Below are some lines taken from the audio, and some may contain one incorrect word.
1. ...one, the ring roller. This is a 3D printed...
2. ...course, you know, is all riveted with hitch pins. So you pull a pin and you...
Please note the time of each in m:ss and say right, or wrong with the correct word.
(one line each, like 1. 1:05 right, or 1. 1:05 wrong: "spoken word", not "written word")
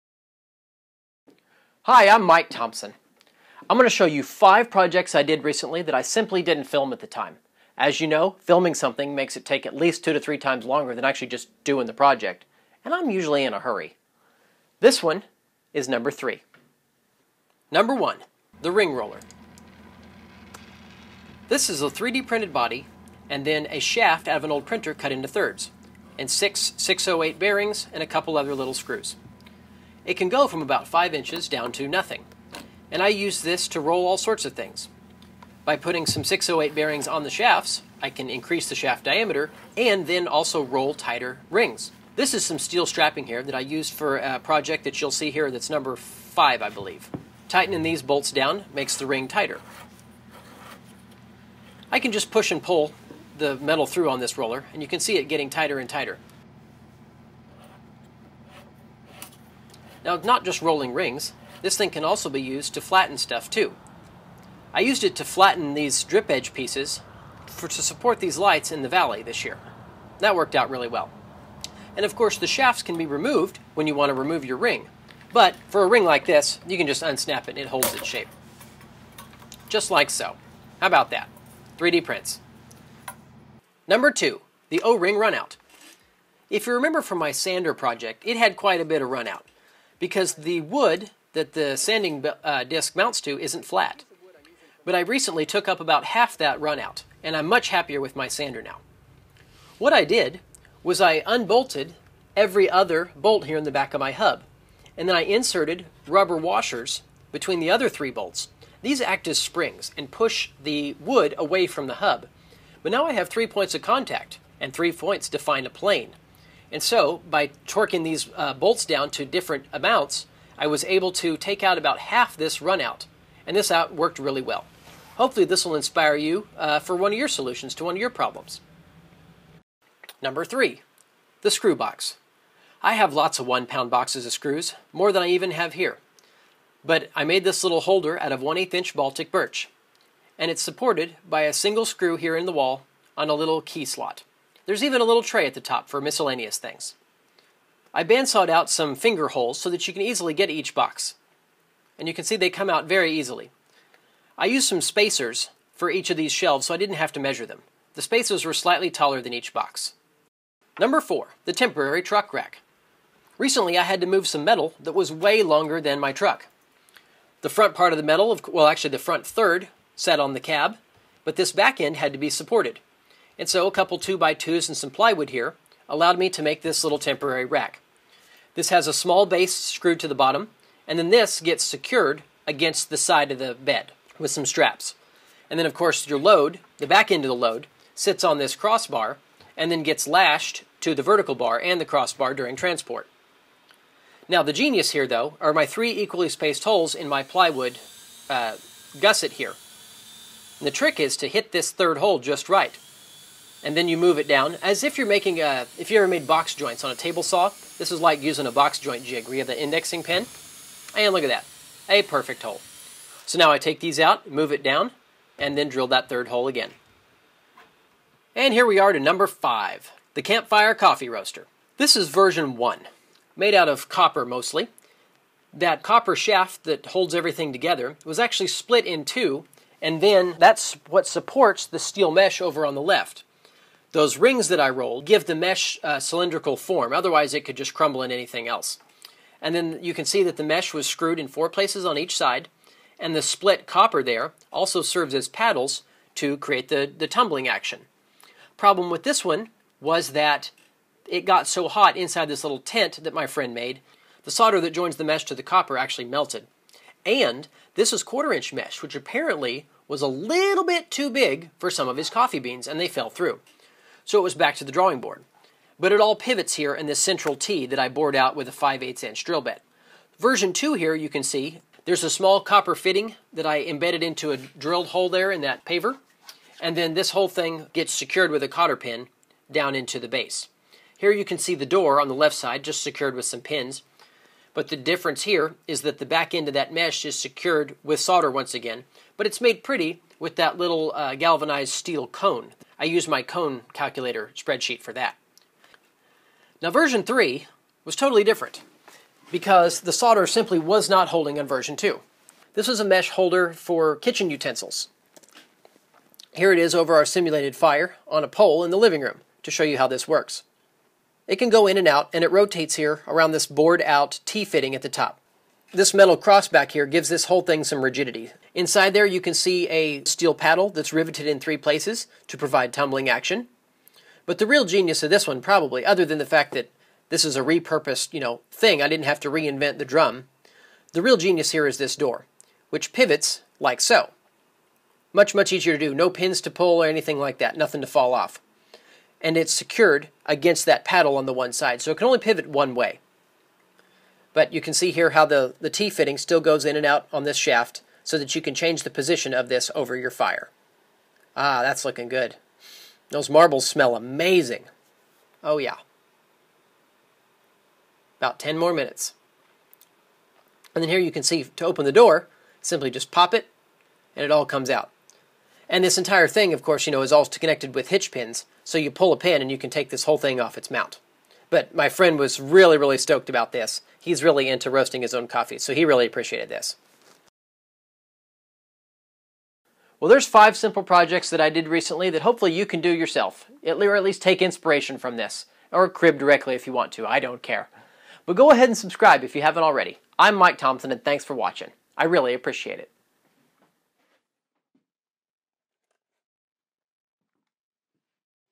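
1. 0:17 right
2. 6:06 wrong: "connected", not "riveted".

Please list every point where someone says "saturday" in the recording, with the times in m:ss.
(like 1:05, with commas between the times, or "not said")
not said.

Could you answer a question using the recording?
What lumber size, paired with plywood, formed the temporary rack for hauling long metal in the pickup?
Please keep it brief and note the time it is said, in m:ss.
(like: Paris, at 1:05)
2 by 2s, at 2:53.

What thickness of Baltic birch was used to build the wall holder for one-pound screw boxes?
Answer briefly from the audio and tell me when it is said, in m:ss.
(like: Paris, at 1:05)
1/8 inch, at 2:18.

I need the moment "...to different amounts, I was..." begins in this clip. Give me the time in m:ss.
1:59.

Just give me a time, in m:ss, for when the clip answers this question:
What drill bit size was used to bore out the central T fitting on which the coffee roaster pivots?
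4:28.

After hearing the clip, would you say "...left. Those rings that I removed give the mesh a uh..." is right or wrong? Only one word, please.
wrong.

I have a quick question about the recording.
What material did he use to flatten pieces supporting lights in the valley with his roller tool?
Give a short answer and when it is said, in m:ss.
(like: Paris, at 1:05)
drip edge, at 1:06.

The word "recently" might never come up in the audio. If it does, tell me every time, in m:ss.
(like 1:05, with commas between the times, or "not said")
0:05, 1:35, 2:43, 6:21.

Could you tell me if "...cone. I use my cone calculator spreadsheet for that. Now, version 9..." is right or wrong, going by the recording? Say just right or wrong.
wrong.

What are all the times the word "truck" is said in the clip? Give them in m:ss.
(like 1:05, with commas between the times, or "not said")
2:42, 2:46.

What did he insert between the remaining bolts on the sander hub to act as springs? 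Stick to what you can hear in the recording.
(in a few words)
rubber washers.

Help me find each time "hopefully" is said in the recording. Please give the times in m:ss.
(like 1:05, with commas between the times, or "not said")
2:05, 6:22.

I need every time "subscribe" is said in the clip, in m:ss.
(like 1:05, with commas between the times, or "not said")
6:28.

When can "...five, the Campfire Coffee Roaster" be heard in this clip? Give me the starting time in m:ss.
3:39.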